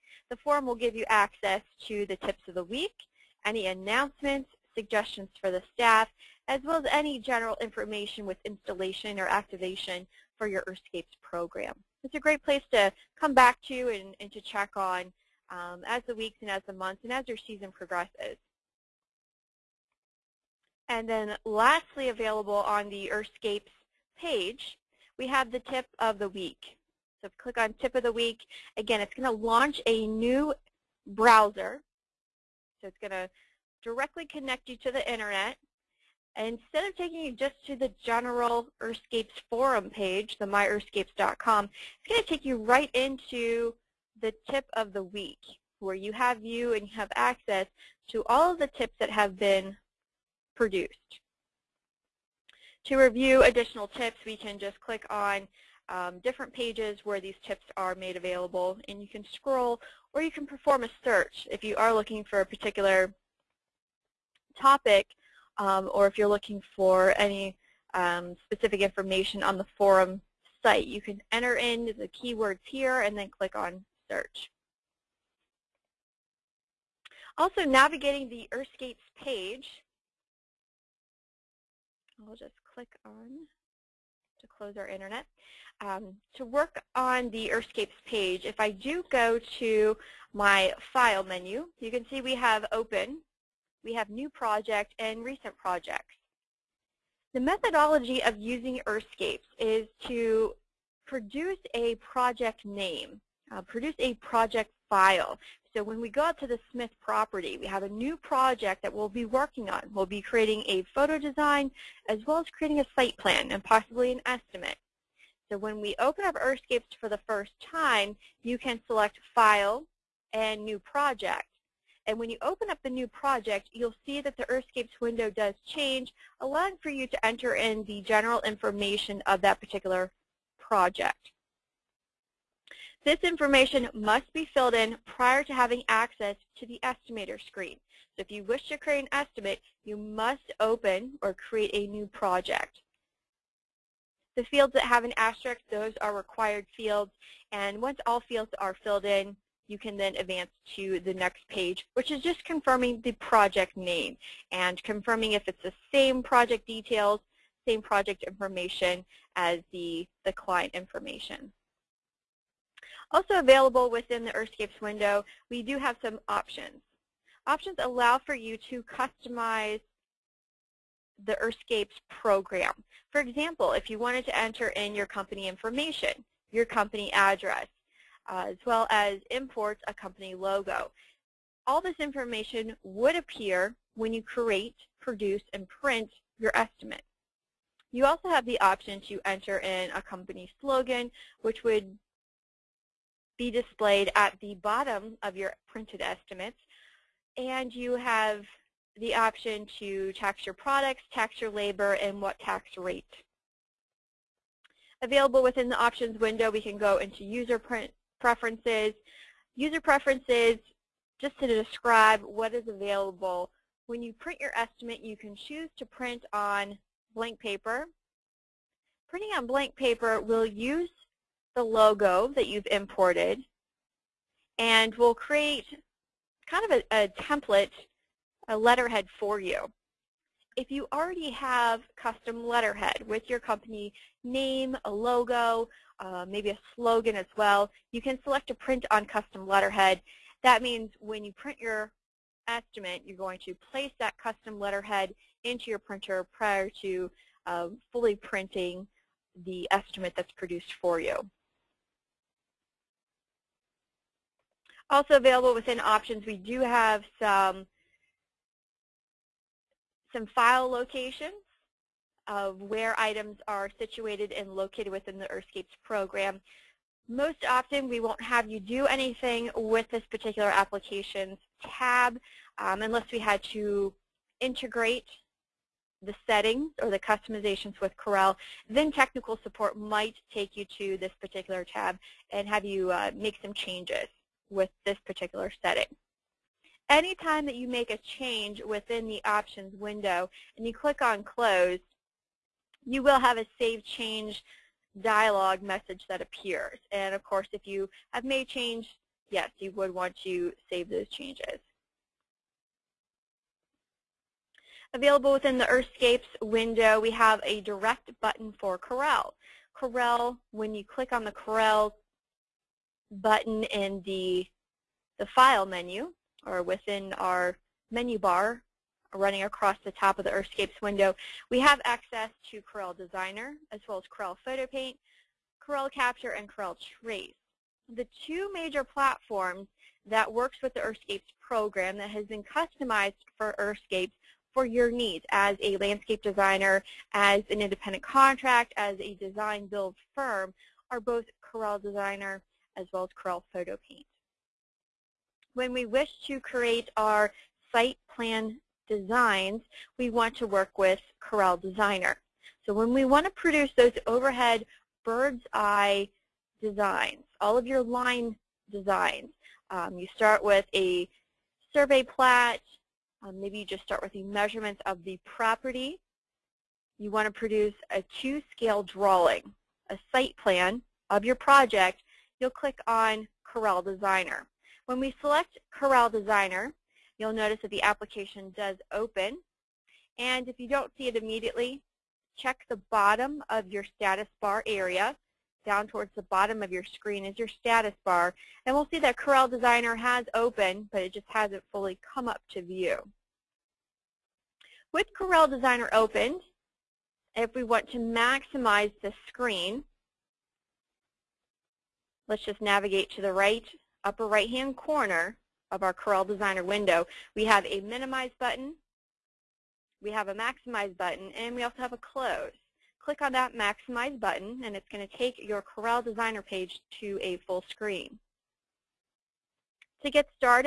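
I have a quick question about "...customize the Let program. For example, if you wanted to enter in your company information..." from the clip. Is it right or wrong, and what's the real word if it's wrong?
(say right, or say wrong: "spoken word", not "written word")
wrong: "Earthscapes", not "Let".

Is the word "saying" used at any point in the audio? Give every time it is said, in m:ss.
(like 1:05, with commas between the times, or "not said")
not said.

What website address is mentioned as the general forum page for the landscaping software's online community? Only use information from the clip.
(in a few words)
myearthscapes.com.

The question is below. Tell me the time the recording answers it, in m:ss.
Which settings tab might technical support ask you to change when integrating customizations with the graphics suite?
4:30.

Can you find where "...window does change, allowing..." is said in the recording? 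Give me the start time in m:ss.
2:04.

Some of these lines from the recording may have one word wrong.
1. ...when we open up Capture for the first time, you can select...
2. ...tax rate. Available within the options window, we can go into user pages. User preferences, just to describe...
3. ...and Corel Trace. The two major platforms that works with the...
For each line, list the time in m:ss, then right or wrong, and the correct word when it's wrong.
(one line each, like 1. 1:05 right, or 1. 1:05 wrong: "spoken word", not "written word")
1. 1:55 wrong: "Earthscapes", not "Capture"
2. 3:22 wrong: "preferences", not "pages"
3. 5:26 right.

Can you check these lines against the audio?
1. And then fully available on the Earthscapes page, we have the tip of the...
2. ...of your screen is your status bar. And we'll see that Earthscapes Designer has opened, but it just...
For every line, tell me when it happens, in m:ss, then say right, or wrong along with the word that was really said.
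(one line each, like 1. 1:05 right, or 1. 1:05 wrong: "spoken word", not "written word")
1. 0:20 wrong: "lastly", not "fully"
2. 6:26 wrong: "Corel", not "Earthscapes".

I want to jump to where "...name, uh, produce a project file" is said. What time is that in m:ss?
1:42.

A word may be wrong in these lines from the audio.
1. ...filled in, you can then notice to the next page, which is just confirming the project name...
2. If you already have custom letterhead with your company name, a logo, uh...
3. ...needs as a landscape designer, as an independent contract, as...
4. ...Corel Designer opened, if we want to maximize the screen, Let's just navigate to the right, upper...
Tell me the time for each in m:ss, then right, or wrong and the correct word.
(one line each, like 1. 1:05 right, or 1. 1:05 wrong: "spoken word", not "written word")
1. 2:28 wrong: "advance", not "notice"
2. 3:50 right
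3. 5:34 right
4. 6:35 right.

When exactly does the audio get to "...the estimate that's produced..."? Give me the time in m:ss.
4:09.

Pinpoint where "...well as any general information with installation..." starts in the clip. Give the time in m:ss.
0:06.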